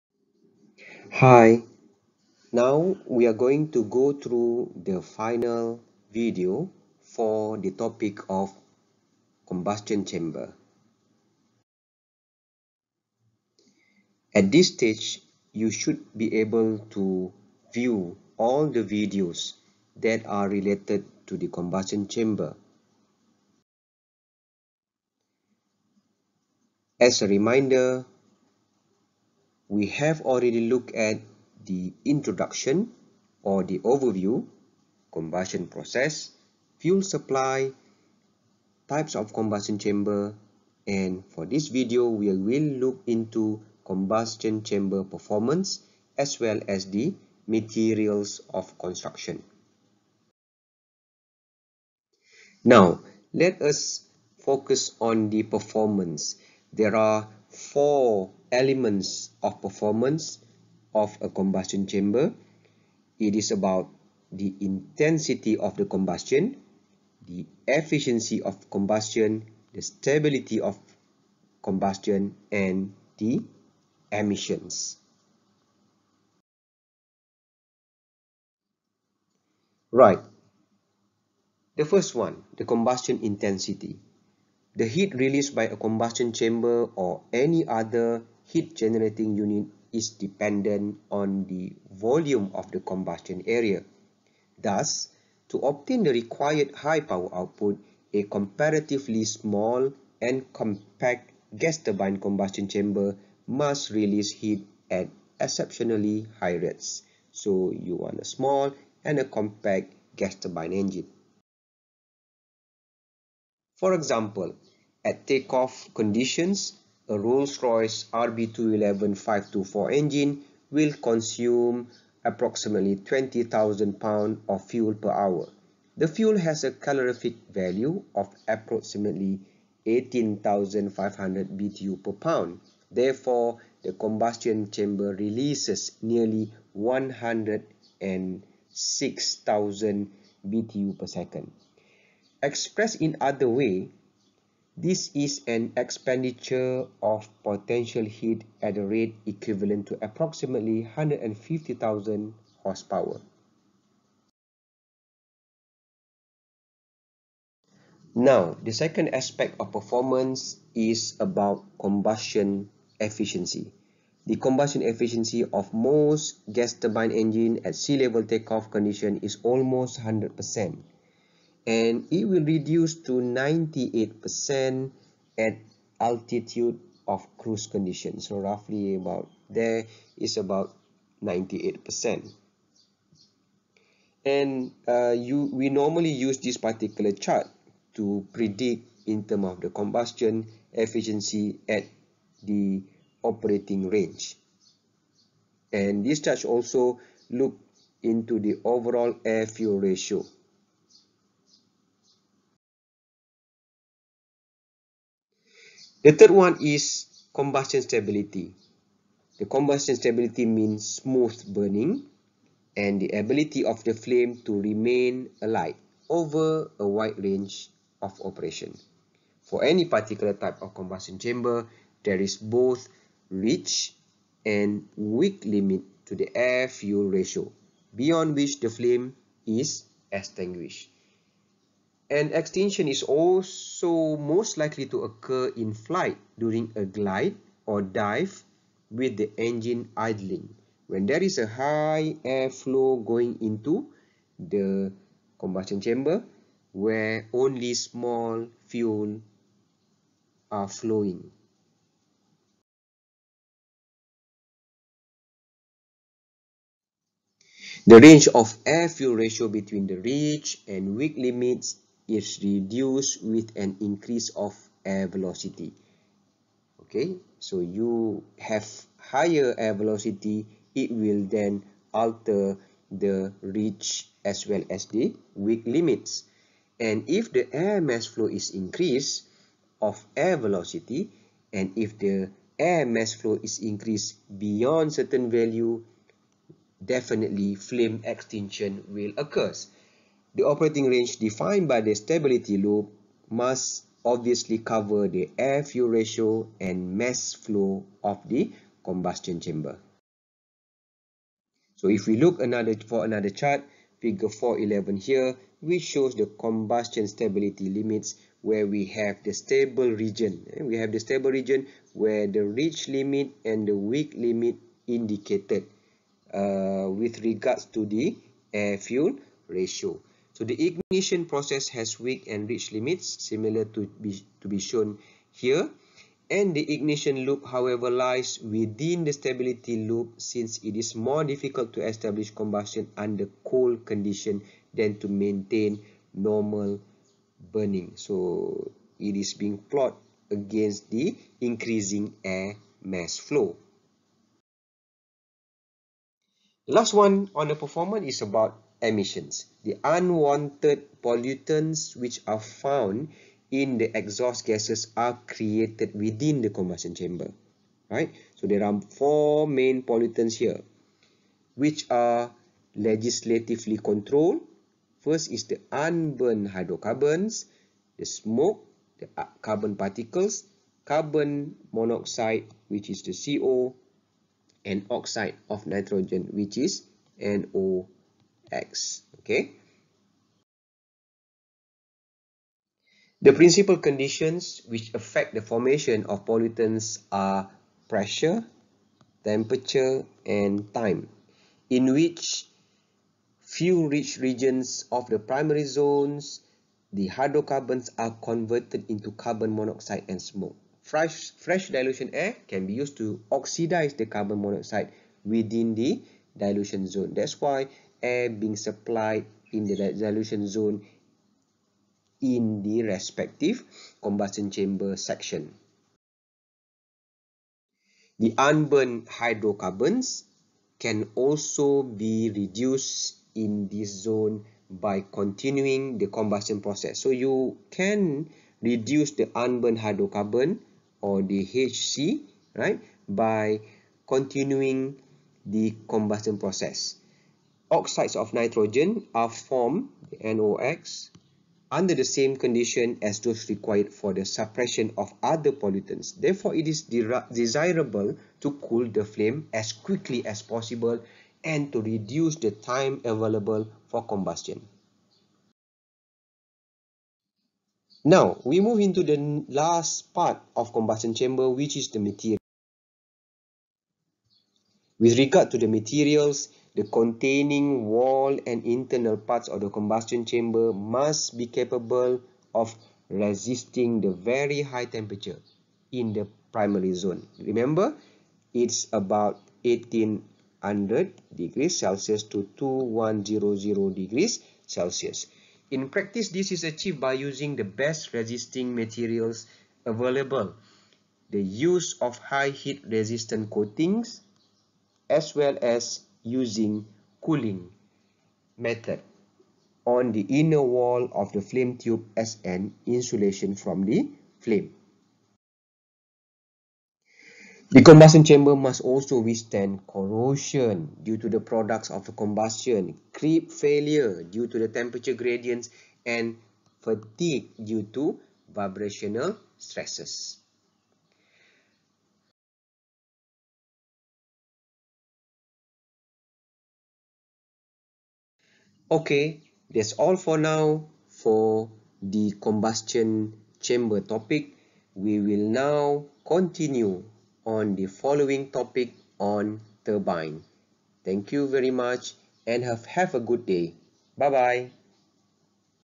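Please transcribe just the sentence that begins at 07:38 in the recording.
Now, we move into the last part of combustion chamber, which is the material.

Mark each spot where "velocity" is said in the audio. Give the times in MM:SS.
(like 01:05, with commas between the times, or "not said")
04:25, 04:29, 04:40.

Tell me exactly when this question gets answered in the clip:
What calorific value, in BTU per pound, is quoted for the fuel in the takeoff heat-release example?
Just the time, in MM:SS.
02:09.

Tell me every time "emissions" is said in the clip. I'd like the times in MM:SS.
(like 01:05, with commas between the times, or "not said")
01:14, 05:48.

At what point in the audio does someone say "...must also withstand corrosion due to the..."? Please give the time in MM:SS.
08:28.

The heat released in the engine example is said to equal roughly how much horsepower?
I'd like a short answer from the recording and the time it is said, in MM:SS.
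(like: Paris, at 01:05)
150,000, at 02:30.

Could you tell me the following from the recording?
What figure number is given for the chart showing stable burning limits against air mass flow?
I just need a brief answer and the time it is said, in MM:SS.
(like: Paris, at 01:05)
4.11, at 05:03.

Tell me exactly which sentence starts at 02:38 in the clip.
Now, the second aspect of performance is about combustion efficiency.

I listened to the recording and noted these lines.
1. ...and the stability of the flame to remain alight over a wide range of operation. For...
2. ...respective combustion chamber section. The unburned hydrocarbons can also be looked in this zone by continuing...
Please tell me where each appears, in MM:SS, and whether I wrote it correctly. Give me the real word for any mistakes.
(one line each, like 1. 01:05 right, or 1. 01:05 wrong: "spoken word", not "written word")
1. 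03:32 wrong: "ability", not "stability"
2. 06:52 wrong: "reduced", not "looked".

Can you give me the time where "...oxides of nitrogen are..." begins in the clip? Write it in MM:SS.
07:17.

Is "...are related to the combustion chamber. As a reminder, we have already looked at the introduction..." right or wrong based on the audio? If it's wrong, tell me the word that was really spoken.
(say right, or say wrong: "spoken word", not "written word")
right.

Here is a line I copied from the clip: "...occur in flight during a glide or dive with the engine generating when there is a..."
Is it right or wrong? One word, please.
wrong.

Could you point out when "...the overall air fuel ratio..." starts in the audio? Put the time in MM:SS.
03:18.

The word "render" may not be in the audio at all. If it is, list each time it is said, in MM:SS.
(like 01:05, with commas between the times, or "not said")
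not said.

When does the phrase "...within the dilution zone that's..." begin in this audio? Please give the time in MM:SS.
06:45.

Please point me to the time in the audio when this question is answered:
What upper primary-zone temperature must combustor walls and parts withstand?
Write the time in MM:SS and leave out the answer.
08:02.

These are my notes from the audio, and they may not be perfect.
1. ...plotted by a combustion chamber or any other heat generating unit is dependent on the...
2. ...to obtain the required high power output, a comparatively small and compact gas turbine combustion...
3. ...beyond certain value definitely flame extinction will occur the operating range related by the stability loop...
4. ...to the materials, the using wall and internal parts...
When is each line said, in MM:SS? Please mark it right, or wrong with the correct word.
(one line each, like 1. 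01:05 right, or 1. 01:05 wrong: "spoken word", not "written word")
1. 01:25 wrong: "released", not "plotted"
2. 01:35 right
3. 04:44 wrong: "defined", not "related"
4. 07:45 wrong: "containing", not "using".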